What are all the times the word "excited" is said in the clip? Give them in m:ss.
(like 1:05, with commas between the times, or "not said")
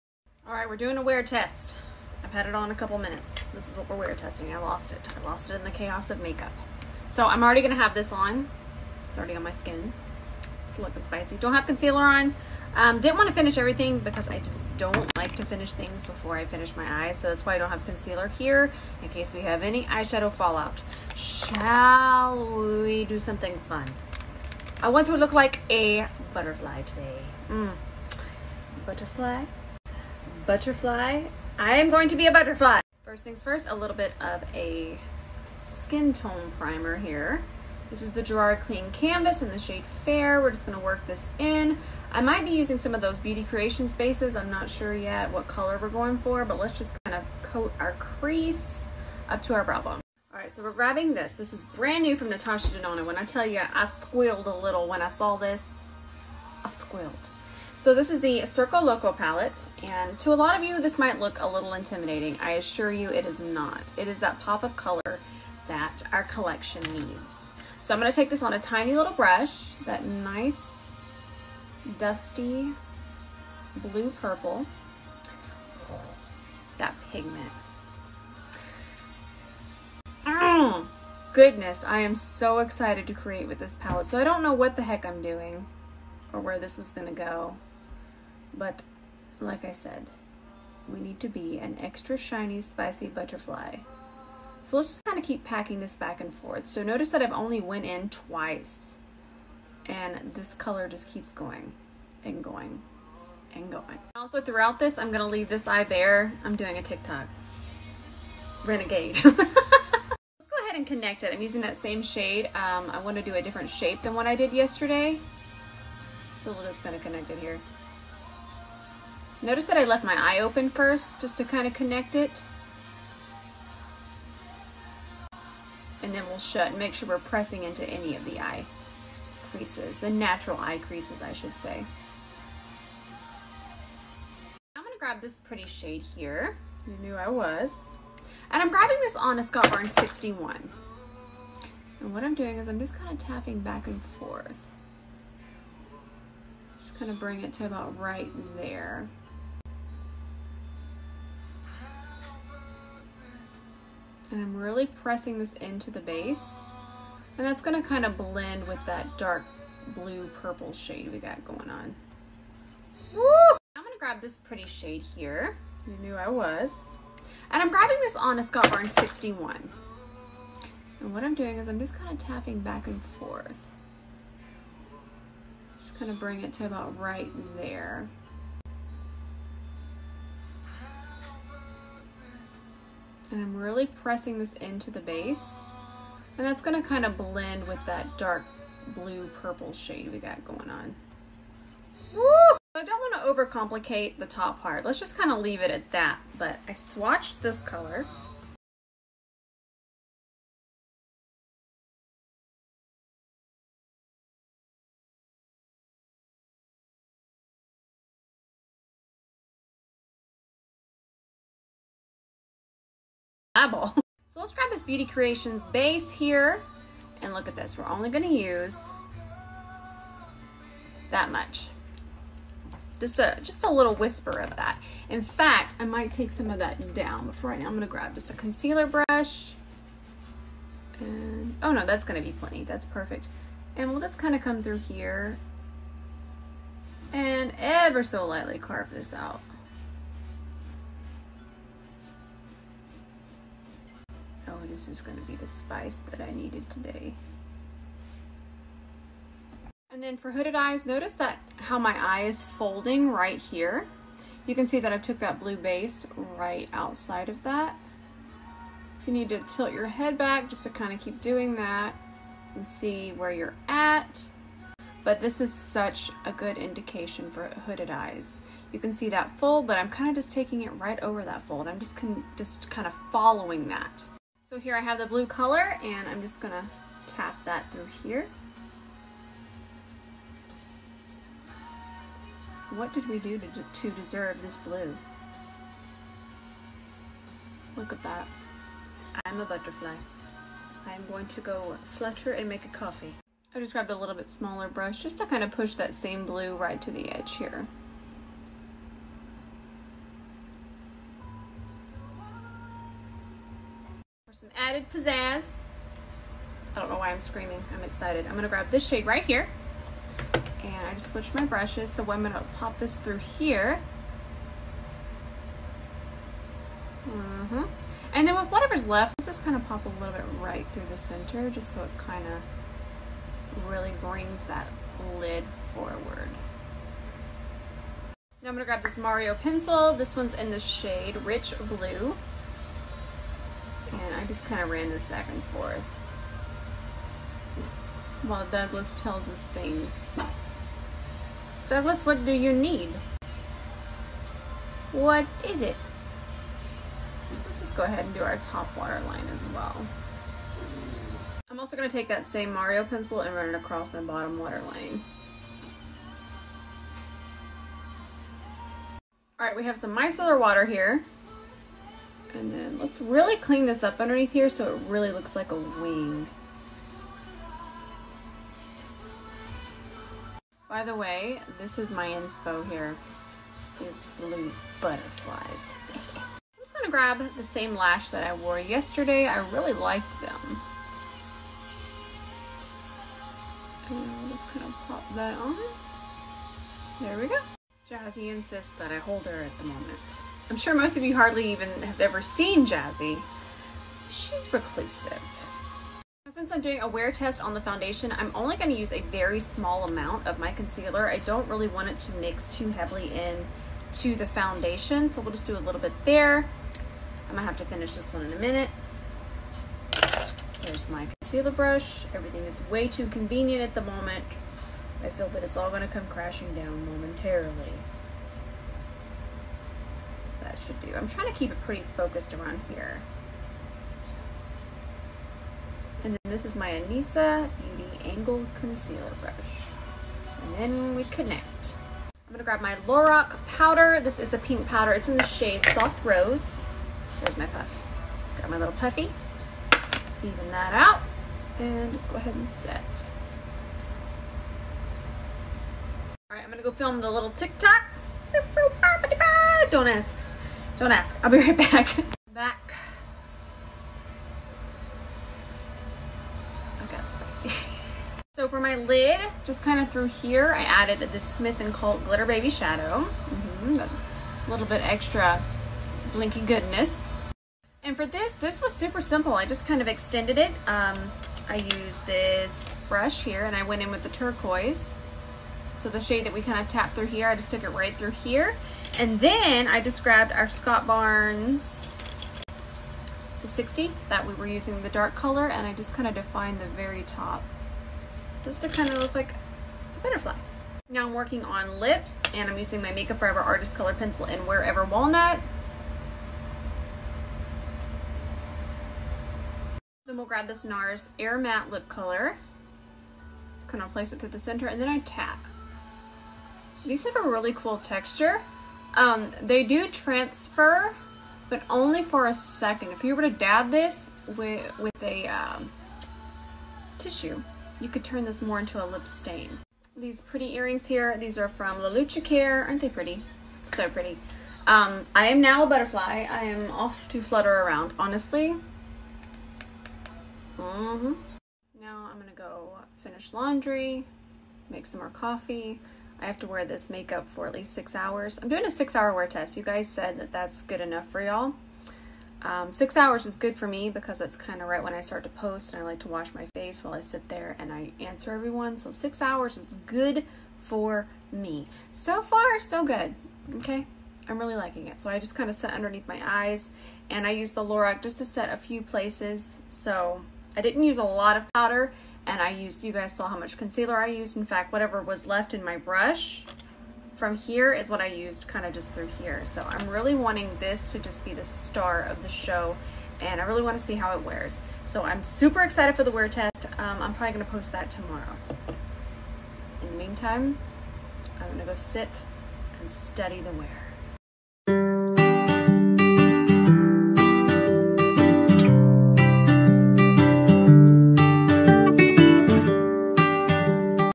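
1:22, 5:07, 9:35.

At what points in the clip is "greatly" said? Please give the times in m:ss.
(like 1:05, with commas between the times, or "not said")
not said.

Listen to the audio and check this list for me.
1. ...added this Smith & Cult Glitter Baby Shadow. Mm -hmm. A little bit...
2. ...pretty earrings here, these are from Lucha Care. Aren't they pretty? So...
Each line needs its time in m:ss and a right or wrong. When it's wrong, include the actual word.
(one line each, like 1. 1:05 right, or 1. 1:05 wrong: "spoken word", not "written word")
1. 7:40 right
2. 8:40 right.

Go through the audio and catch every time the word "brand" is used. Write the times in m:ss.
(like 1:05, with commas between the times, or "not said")
0:51.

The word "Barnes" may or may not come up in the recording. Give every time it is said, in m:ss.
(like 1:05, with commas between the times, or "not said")
2:19, 2:48, 8:00.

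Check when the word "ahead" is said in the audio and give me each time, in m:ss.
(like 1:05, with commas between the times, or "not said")
1:50, 5:47, 7:22.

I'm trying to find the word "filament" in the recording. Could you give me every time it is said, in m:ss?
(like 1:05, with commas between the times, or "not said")
not said.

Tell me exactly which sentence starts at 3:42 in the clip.
Just a, just a little whisper of that.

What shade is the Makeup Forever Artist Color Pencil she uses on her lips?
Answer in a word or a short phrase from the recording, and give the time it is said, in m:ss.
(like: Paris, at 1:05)
Wherever Walnut, at 8:14.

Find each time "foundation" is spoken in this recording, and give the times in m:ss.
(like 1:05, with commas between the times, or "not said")
6:37, 6:44.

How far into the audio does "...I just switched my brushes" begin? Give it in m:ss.
5:10.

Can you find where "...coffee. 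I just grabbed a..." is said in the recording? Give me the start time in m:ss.
4:52.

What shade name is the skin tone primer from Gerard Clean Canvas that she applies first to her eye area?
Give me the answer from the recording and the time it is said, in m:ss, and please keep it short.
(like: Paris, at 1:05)
Fair, at 0:40.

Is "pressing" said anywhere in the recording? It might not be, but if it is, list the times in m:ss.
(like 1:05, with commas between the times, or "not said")
2:07, 2:34, 3:03.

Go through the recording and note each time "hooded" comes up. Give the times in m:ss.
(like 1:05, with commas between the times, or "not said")
4:10, 4:27.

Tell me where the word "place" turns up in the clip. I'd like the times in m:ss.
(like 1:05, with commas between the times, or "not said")
8:23, 9:18.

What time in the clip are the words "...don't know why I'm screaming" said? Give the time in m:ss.
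5:06.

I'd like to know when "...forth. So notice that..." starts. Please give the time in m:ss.
1:36.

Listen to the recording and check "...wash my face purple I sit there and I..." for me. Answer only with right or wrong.
wrong.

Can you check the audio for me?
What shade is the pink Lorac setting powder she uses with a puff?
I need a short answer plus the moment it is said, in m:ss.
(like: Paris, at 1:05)
Soft Rose, at 7:15.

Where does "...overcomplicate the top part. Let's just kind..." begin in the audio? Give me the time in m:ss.
3:13.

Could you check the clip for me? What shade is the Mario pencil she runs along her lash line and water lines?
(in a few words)
Rich Blue.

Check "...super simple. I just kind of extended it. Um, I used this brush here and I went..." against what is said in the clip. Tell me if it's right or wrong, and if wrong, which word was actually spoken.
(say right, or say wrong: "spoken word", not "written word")
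right.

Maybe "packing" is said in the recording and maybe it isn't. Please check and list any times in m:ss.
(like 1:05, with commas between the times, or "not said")
1:35.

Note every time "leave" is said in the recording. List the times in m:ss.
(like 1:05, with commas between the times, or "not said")
1:45, 3:15.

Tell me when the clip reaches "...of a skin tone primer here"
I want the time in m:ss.
0:34.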